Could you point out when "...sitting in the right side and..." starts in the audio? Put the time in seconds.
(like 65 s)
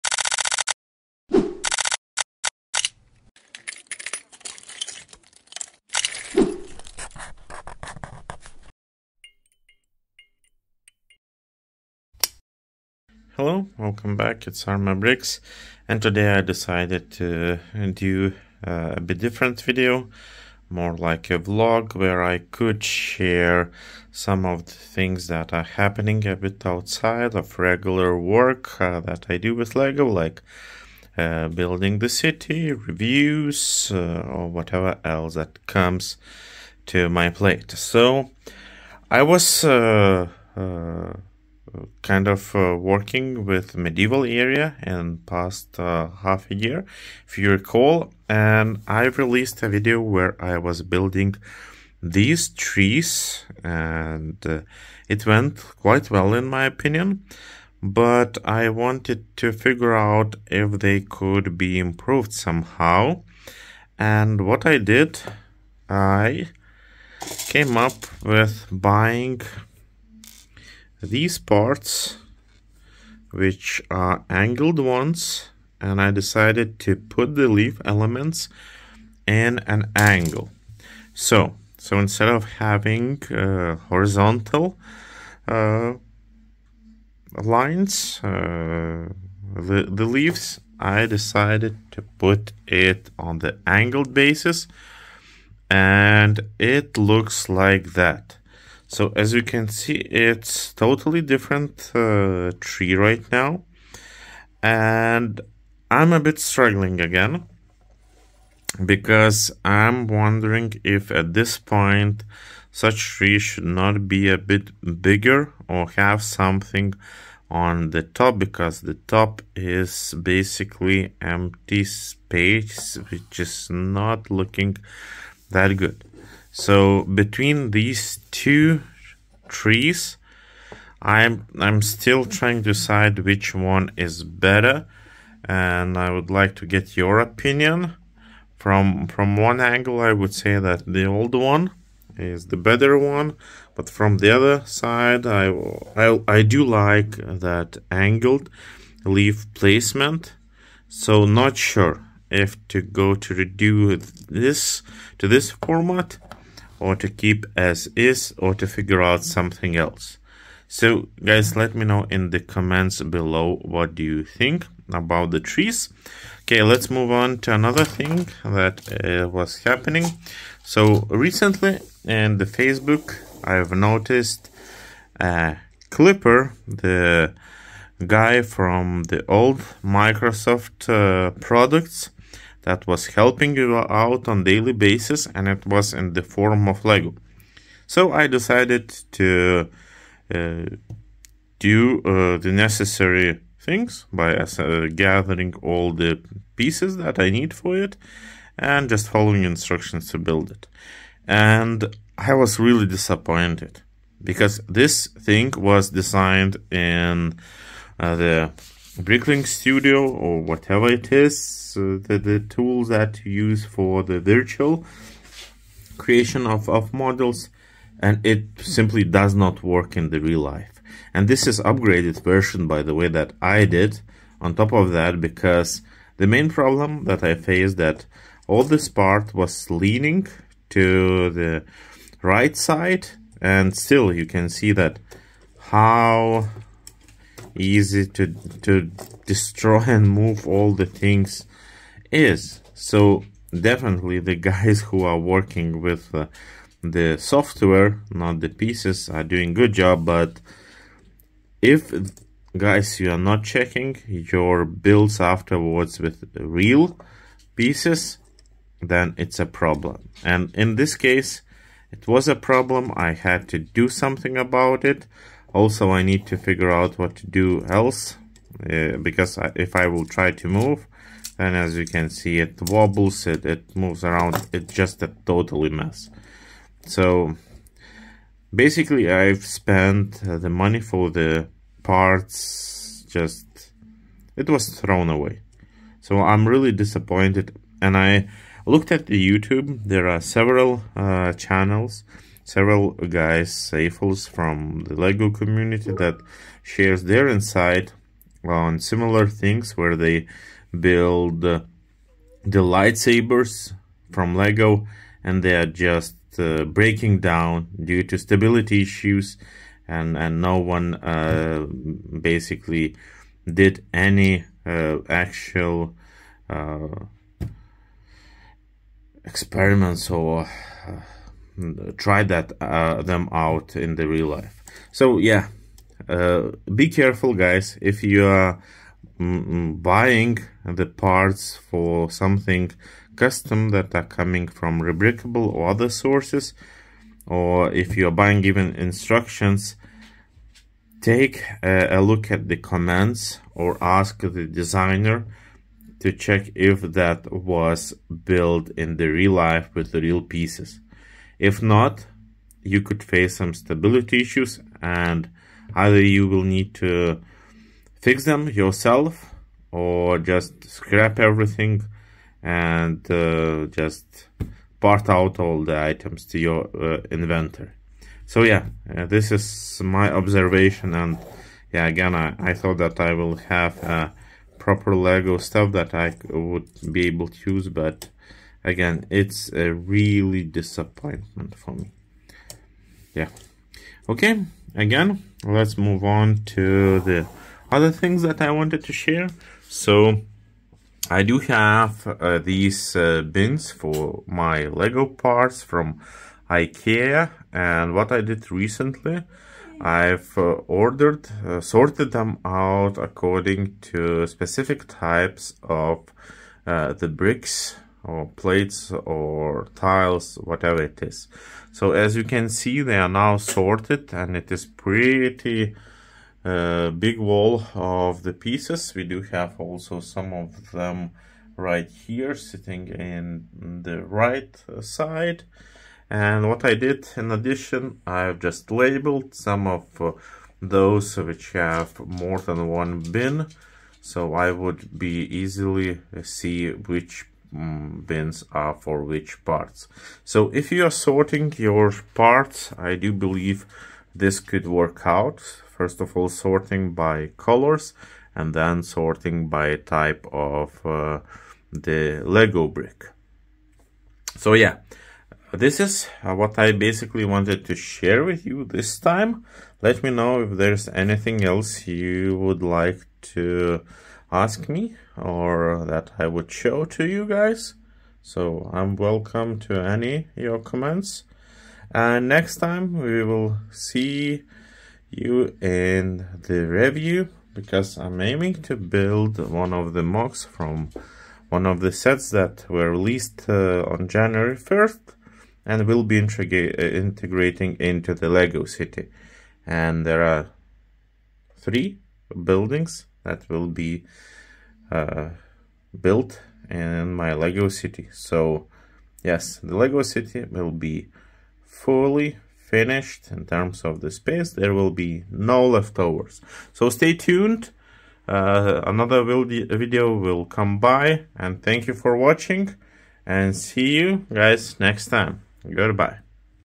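422 s.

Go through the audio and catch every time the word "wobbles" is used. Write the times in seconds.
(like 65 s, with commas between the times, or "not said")
272 s.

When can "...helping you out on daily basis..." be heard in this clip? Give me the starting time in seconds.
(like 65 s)
183 s.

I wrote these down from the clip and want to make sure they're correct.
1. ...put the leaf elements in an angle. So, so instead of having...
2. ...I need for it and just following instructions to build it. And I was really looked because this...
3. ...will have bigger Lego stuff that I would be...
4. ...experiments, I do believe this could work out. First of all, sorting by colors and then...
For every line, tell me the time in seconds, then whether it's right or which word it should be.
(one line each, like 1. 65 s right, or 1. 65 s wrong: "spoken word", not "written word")
1. 76 s right
2. 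197 s wrong: "disappointed", not "looked"
3. 373 s wrong: "proper", not "bigger"
4. 442 s wrong: "parts", not "experiments".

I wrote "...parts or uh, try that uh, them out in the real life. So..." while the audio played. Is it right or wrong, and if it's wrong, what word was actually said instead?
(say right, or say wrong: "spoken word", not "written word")
wrong: "experiments", not "parts".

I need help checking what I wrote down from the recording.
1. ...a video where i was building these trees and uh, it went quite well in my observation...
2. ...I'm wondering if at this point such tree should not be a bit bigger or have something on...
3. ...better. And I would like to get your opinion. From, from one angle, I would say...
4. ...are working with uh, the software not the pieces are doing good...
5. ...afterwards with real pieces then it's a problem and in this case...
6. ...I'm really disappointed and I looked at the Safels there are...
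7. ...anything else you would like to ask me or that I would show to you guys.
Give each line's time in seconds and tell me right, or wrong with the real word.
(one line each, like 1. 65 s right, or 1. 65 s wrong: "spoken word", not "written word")
1. 49 s wrong: "opinion", not "observation"
2. 109 s right
3. 134 s right
4. 245 s right
5. 255 s right
6. 286 s wrong: "YouTube", not "Safels"
7. 460 s right.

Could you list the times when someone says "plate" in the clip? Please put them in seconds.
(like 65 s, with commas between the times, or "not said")
37 s, 408 s.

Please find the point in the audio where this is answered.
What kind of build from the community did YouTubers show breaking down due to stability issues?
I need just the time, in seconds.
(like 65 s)
302 s.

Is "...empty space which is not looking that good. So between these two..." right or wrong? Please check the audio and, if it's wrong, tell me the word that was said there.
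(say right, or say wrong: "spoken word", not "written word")
right.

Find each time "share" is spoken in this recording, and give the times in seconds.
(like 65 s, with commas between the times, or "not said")
22 s, 296 s, 388 s, 457 s.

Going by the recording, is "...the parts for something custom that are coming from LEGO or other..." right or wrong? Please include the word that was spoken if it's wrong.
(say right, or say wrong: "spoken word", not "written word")
wrong: "Rebrickable", not "LEGO".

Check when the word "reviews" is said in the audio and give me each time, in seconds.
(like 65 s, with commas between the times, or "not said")
32 s, 476 s.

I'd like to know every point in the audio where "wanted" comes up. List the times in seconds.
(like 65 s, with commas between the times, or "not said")
58 s, 388 s, 457 s.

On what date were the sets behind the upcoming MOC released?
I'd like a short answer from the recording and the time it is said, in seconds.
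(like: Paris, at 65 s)
January 1st, at 484 s.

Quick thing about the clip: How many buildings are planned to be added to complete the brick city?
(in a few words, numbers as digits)
3.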